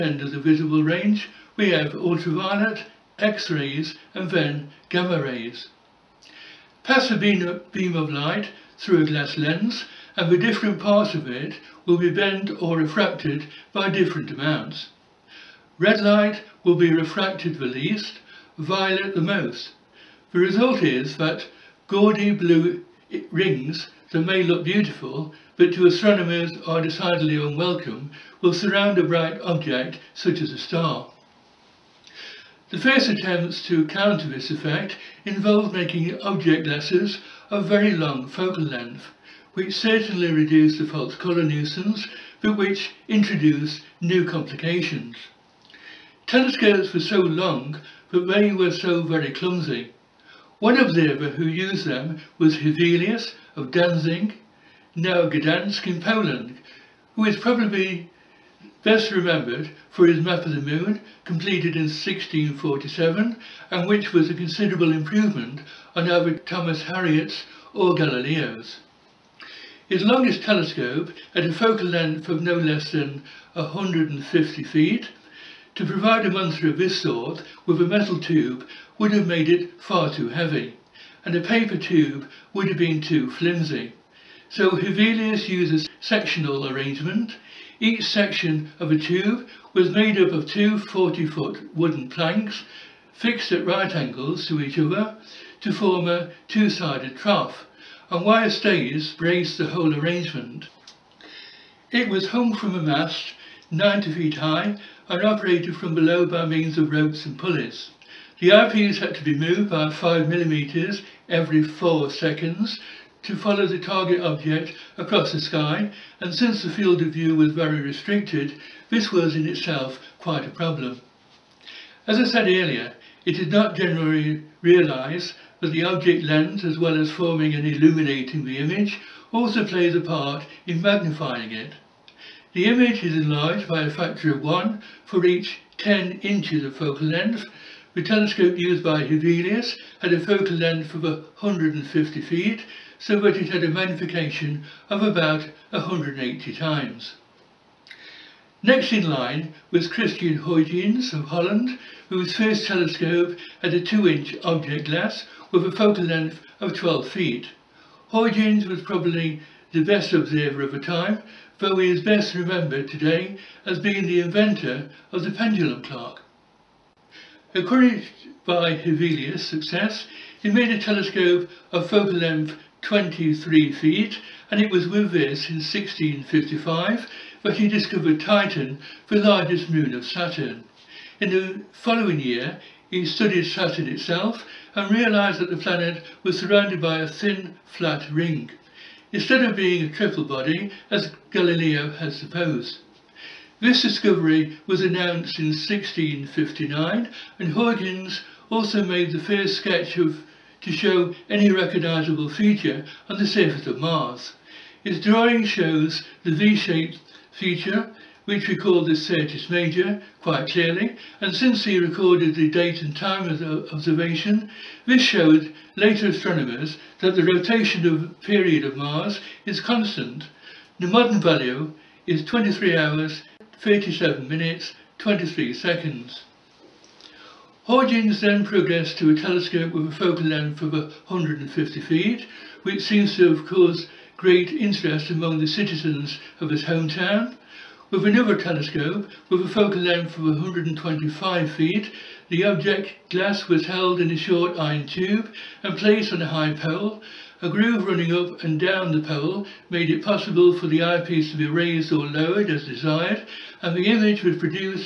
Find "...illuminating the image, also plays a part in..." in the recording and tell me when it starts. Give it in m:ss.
2:07.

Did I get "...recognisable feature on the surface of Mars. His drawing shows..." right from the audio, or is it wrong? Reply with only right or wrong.
right.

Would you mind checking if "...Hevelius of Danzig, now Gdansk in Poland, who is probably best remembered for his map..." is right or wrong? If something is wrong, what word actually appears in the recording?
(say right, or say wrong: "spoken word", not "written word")
right.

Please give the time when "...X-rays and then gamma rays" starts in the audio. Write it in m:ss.
0:03.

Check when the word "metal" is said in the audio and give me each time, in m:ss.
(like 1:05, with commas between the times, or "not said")
1:17.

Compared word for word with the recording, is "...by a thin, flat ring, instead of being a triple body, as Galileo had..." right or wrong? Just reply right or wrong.
right.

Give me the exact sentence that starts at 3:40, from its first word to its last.
The modern value is 23 hours, 37 minutes, 23 seconds.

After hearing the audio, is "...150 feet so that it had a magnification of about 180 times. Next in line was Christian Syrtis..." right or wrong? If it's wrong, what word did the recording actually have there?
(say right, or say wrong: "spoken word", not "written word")
wrong: "Huygens", not "Syrtis".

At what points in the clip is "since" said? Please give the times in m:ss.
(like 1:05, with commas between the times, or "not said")
1:56, 3:31.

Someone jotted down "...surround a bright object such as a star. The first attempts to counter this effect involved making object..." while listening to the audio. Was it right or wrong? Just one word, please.
right.